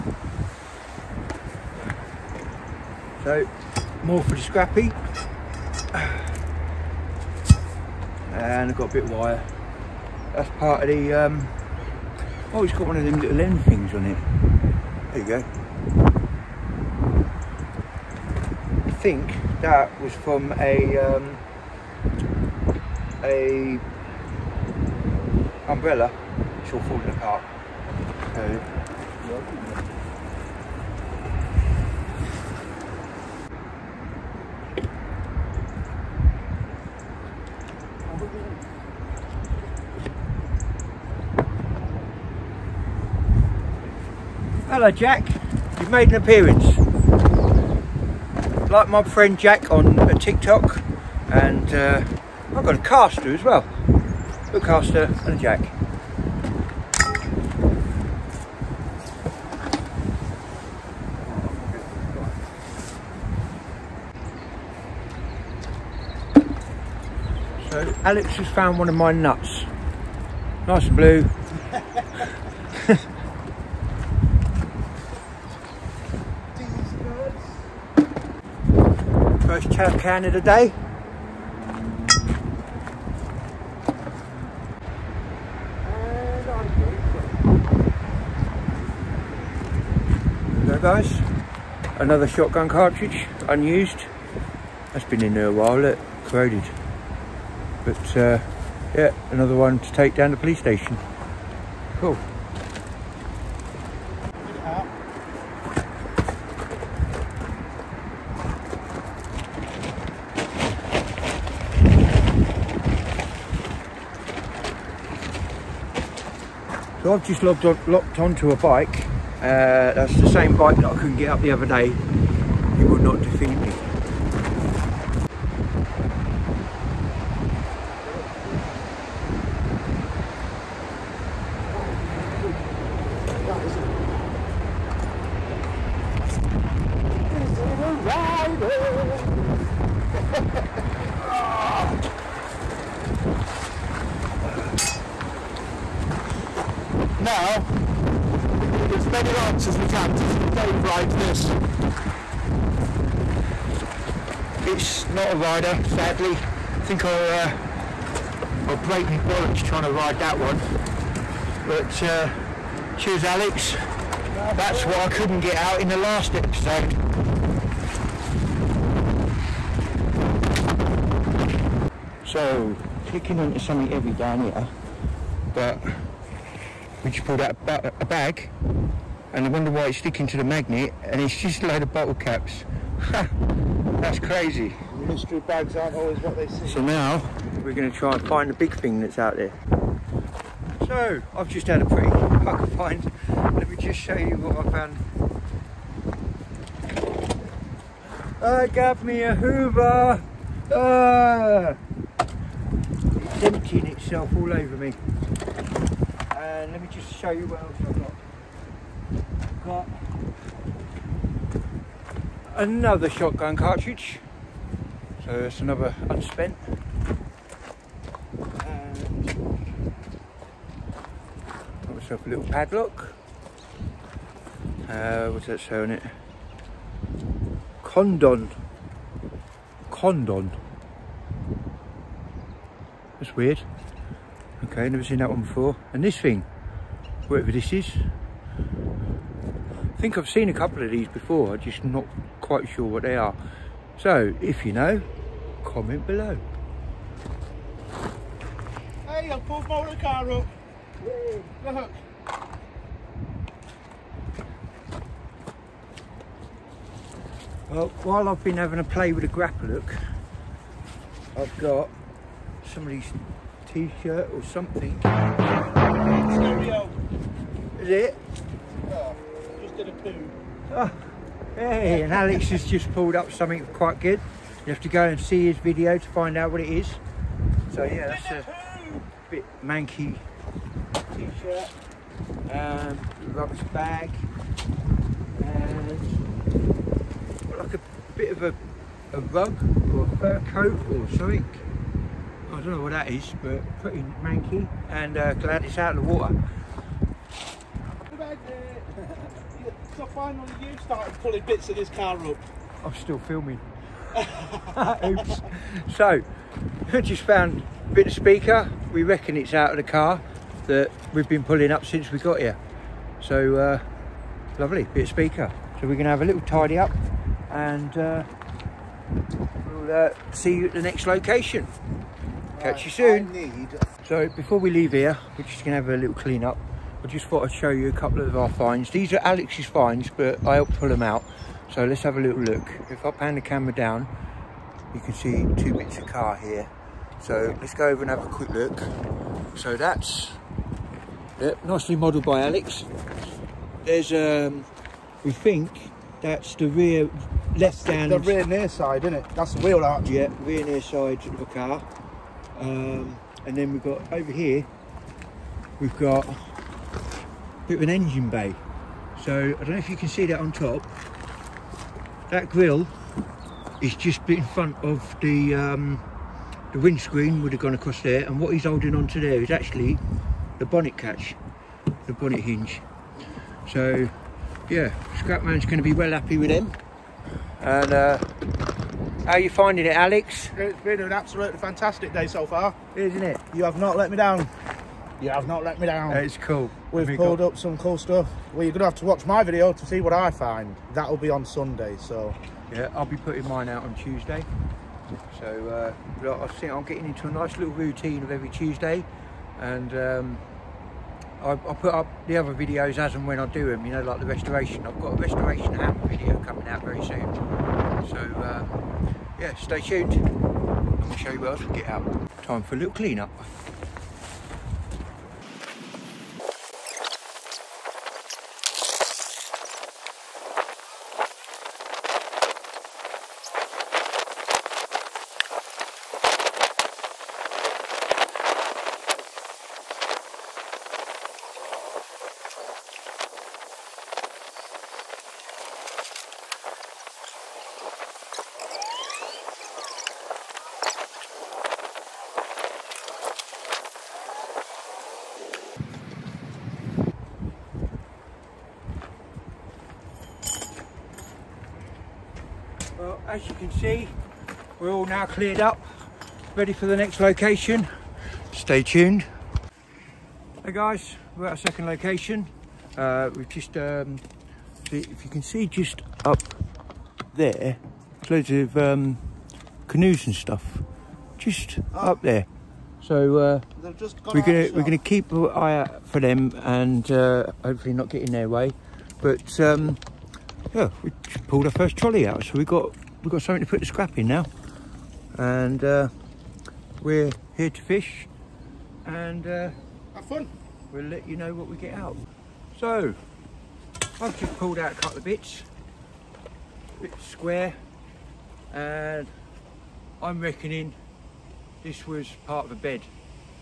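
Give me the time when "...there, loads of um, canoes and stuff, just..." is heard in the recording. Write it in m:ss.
7:47.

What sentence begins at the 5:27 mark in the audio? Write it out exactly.
I just thought I'd show you a couple of our finds.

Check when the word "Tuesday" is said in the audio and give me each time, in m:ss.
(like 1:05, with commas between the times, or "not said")
6:33, 6:38.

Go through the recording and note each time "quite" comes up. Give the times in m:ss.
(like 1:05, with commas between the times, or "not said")
4:02, 4:33.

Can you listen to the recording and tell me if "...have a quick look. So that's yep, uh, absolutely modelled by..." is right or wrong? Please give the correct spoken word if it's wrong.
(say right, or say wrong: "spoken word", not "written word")
wrong: "nicely", not "absolutely".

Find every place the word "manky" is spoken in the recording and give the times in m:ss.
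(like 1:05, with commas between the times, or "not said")
4:39, 4:54.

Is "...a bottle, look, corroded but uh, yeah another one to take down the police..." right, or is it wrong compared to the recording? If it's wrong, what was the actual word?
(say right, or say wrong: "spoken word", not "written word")
wrong: "while", not "bottle".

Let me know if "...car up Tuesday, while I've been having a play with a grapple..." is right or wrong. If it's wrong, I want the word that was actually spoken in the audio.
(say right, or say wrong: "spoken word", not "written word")
wrong: "Well", not "Tuesday".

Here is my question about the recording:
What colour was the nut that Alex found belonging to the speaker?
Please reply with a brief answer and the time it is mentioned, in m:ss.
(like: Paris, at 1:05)
blue, at 1:10.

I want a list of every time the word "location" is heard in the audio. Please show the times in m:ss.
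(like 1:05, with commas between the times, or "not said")
5:21, 7:37, 7:41.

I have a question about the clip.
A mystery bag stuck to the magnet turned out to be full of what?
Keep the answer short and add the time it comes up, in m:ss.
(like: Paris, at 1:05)
bottle caps, at 3:01.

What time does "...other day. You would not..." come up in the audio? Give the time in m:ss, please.
2:01.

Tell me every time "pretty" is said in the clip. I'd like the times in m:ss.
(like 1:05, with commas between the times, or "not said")
3:11, 4:53.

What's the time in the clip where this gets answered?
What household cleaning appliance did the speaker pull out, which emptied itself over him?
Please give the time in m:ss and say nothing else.
3:19.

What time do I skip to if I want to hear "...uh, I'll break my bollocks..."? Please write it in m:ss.
2:37.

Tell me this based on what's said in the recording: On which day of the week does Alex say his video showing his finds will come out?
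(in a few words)
Sunday.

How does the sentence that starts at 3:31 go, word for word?
I've got another shotgun cartridge, so it's another unspent.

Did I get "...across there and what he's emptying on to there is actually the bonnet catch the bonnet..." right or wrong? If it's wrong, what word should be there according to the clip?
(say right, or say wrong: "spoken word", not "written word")
wrong: "holding", not "emptying".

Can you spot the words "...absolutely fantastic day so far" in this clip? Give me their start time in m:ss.
6:21.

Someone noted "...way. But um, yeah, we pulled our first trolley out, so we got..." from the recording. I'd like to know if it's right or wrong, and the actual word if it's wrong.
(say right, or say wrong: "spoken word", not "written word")
right.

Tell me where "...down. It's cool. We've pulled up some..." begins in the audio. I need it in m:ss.
6:25.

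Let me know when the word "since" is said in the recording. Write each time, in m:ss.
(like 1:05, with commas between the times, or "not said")
5:11.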